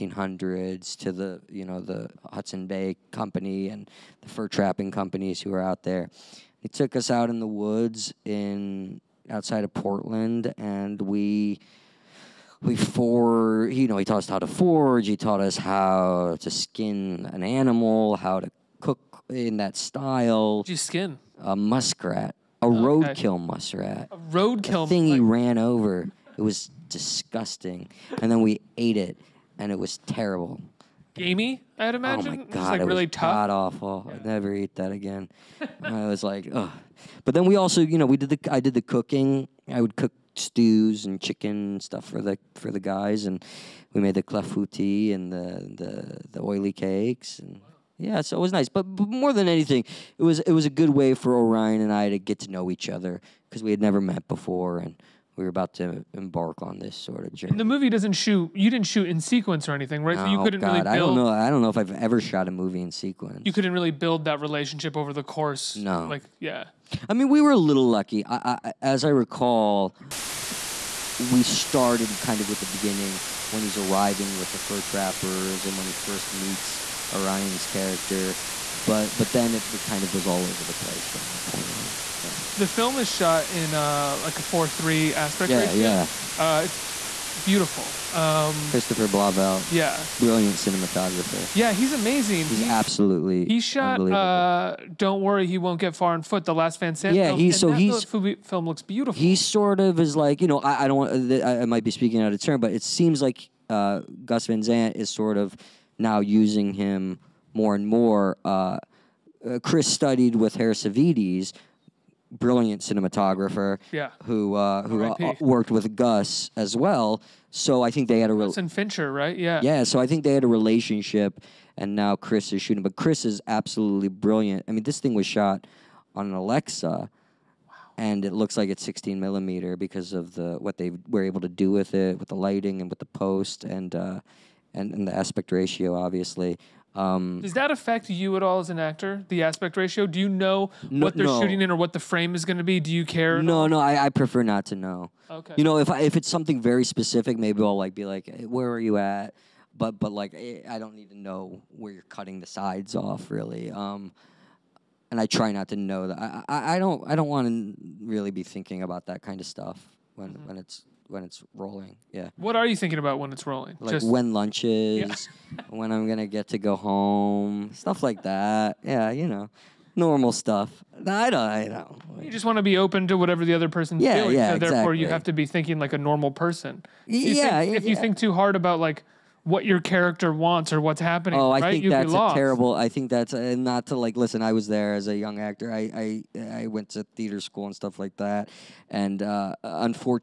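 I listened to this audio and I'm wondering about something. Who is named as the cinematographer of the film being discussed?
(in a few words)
Christopher Blauvelt.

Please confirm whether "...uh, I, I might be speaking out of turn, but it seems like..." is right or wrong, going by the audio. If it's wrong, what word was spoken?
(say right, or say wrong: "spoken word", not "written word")
right.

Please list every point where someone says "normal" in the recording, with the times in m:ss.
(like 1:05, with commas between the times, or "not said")
2:49, 2:55.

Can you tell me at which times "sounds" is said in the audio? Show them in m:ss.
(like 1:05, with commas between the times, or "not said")
not said.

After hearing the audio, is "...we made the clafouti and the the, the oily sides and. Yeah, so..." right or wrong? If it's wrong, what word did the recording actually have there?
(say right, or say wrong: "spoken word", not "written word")
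wrong: "cakes", not "sides".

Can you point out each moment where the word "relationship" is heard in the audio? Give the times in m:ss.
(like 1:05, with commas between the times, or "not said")
1:04, 2:00.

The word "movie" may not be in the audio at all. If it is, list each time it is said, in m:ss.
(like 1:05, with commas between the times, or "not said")
0:57, 1:02.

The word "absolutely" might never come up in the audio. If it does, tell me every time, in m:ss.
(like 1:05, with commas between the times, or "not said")
1:32, 2:03.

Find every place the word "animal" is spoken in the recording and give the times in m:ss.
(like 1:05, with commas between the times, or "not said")
0:17.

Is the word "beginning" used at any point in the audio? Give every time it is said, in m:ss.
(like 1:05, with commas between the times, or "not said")
1:12.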